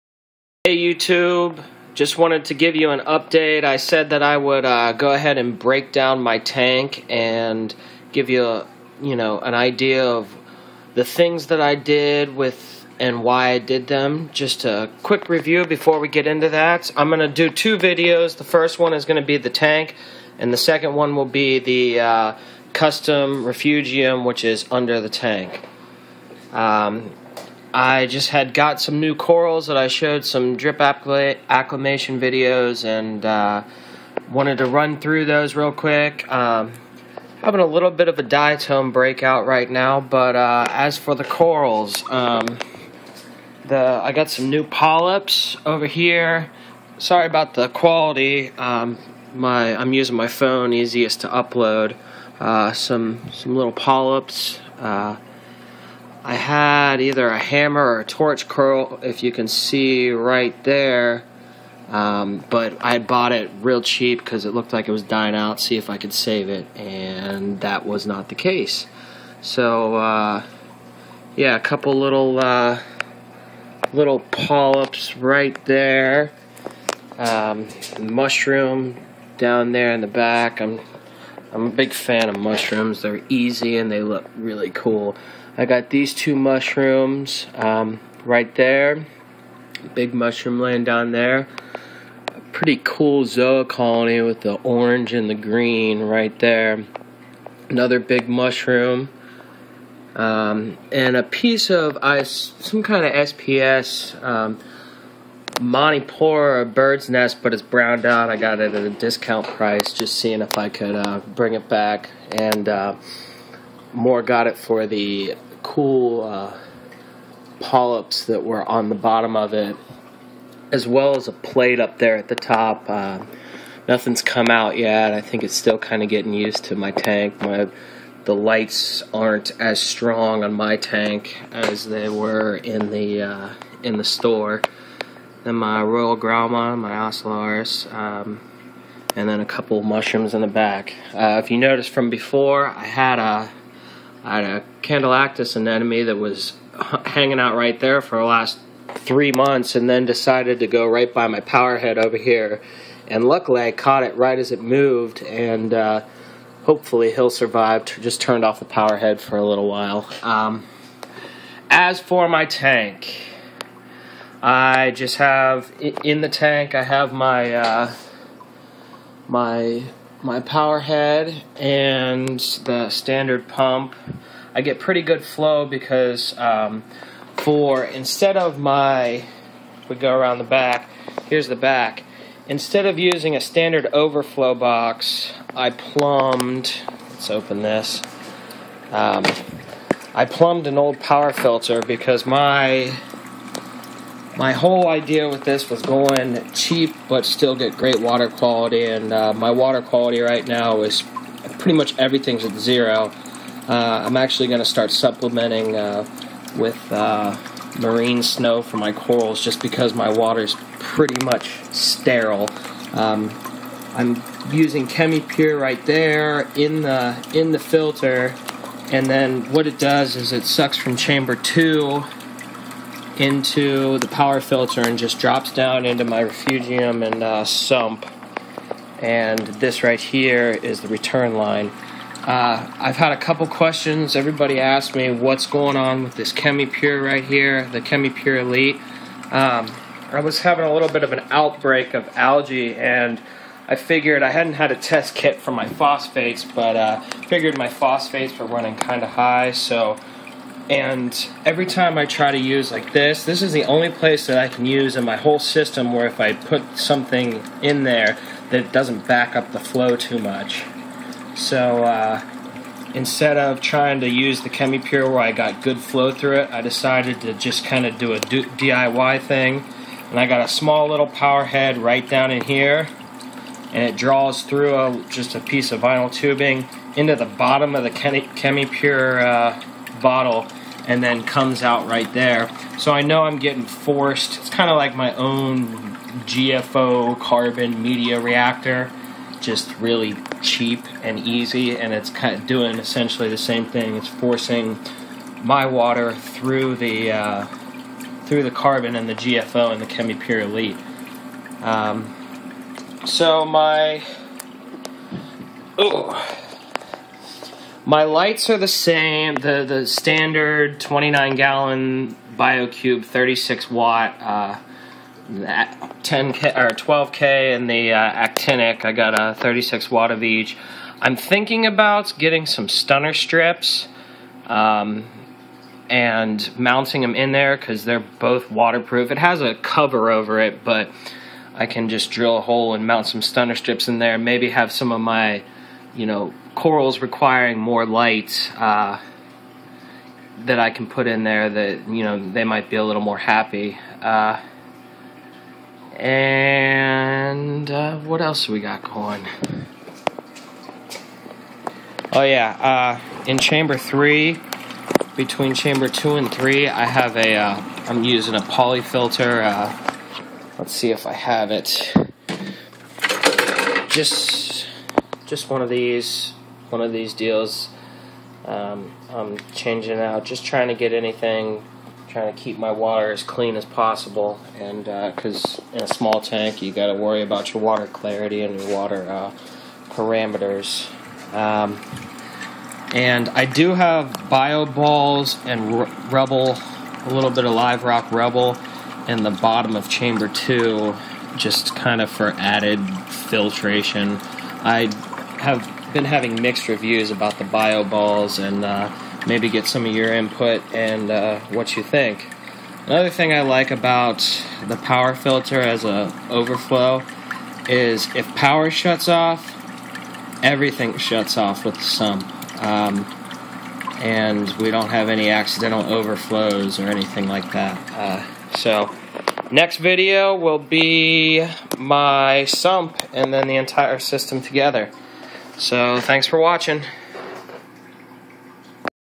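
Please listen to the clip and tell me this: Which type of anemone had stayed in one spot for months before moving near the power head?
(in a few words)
Condylactis.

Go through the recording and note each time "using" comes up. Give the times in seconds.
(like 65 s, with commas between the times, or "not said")
49 s, 182 s, 214 s, 358 s.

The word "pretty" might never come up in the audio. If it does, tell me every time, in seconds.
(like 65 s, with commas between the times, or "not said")
92 s, 174 s, 201 s, 210 s.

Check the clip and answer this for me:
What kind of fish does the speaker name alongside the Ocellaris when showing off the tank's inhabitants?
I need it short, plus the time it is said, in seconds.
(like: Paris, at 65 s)
Royal Gramma, at 135 s.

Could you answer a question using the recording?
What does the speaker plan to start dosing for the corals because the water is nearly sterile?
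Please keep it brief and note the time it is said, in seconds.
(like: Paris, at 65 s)
marine snow, at 207 s.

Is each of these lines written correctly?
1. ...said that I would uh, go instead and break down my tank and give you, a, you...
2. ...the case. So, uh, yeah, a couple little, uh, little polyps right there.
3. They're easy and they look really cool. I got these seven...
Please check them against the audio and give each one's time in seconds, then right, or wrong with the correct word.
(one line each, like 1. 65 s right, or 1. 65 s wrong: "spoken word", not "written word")
1. 3 s wrong: "ahead", not "instead"
2. 68 s right
3. 83 s wrong: "two", not "seven".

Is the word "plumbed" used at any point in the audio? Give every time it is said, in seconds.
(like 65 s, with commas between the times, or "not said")
185 s, 190 s.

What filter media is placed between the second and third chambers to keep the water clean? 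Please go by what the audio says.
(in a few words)
poly filter.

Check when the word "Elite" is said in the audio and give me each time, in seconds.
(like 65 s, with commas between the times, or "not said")
238 s, 300 s.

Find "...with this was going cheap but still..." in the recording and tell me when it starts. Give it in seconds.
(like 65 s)
195 s.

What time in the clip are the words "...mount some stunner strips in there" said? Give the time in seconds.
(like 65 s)
332 s.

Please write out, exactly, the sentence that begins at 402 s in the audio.
Another thing I like about the power filter as a overflow is if power shuts off, everything shuts off with the sump.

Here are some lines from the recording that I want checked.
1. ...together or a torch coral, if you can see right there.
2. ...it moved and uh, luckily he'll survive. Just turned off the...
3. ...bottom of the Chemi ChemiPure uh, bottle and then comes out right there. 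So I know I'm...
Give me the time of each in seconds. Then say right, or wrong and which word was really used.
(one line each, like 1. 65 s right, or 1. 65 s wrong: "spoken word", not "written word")
1. 57 s wrong: "hammer", not "together"
2. 154 s wrong: "hopefully", not "luckily"
3. 277 s right.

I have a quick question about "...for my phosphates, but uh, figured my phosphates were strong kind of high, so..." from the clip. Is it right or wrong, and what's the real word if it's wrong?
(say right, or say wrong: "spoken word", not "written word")
wrong: "running", not "strong".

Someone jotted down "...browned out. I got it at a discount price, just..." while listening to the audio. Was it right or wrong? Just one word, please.
right.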